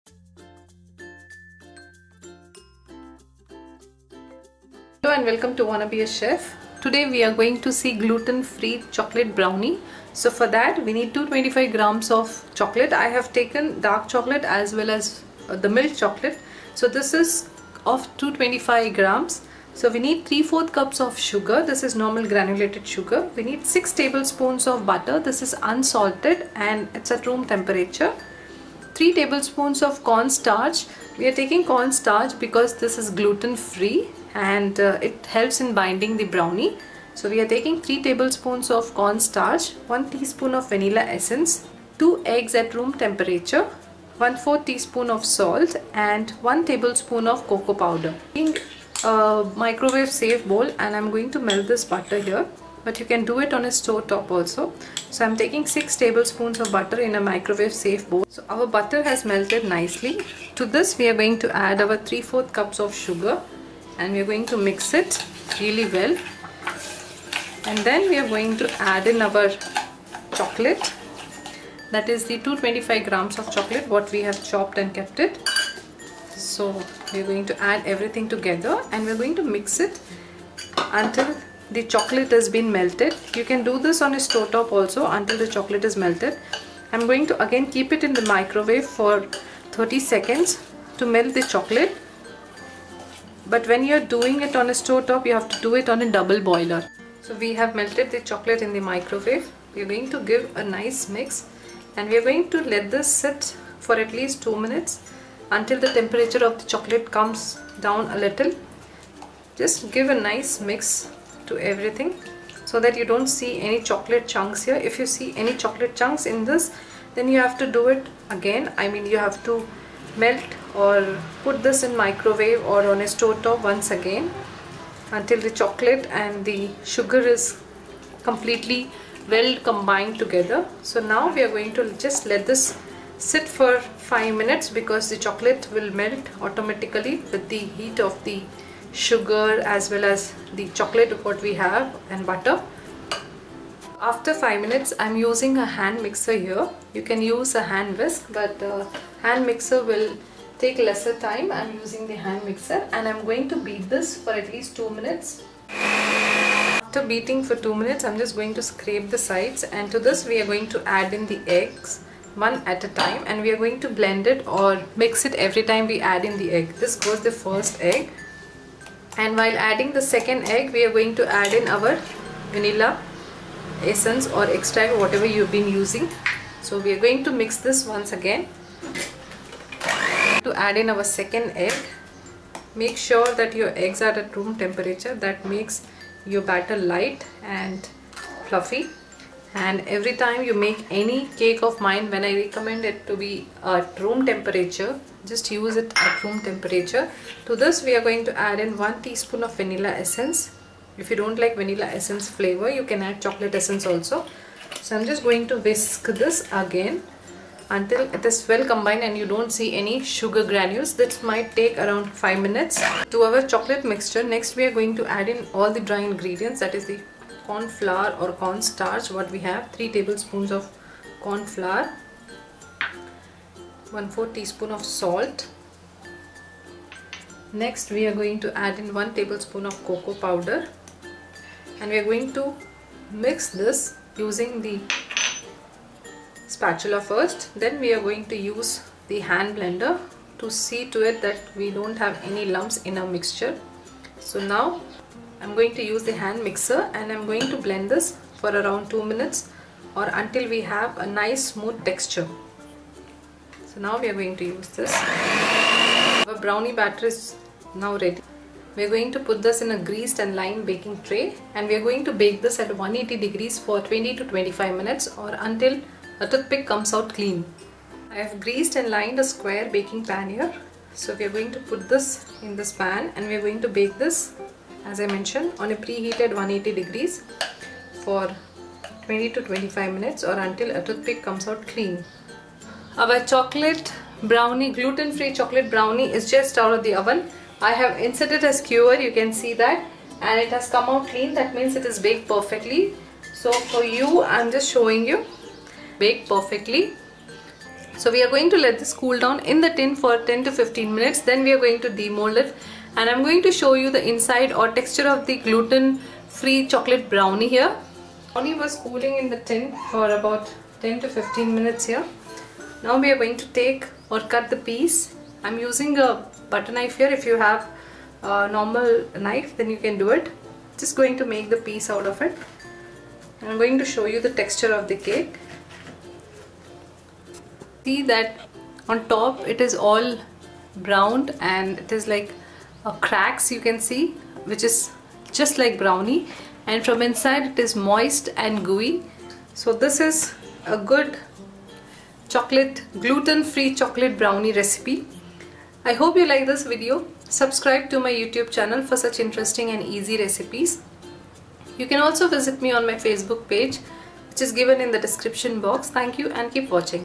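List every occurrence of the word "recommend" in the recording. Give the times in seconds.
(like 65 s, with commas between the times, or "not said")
192 s.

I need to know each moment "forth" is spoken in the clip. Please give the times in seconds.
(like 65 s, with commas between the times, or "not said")
not said.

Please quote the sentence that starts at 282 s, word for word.
Our chocolate brownie, gluten-free chocolate brownie is just out of the oven.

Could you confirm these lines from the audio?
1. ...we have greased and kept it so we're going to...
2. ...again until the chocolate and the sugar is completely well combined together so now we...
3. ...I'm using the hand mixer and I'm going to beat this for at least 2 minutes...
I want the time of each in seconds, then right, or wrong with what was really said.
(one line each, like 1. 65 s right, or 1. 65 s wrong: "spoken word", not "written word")
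1. 74 s wrong: "chopped", not "greased"
2. 123 s right
3. 151 s right.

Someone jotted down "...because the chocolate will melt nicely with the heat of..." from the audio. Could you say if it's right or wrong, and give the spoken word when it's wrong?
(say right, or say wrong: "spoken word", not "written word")
wrong: "automatically", not "nicely".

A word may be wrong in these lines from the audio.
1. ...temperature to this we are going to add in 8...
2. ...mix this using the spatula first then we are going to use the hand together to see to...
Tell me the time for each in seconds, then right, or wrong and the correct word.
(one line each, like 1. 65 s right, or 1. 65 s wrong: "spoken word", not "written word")
1. 196 s wrong: "1", not "8"
2. 233 s wrong: "blender", not "together".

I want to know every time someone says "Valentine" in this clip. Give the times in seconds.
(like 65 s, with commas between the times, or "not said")
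not said.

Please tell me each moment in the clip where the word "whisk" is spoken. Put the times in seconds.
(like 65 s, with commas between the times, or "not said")
147 s, 205 s.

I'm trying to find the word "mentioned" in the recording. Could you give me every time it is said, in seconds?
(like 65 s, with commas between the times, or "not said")
275 s.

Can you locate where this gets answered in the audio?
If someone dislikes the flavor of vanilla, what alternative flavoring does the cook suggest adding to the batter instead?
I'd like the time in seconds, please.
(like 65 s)
203 s.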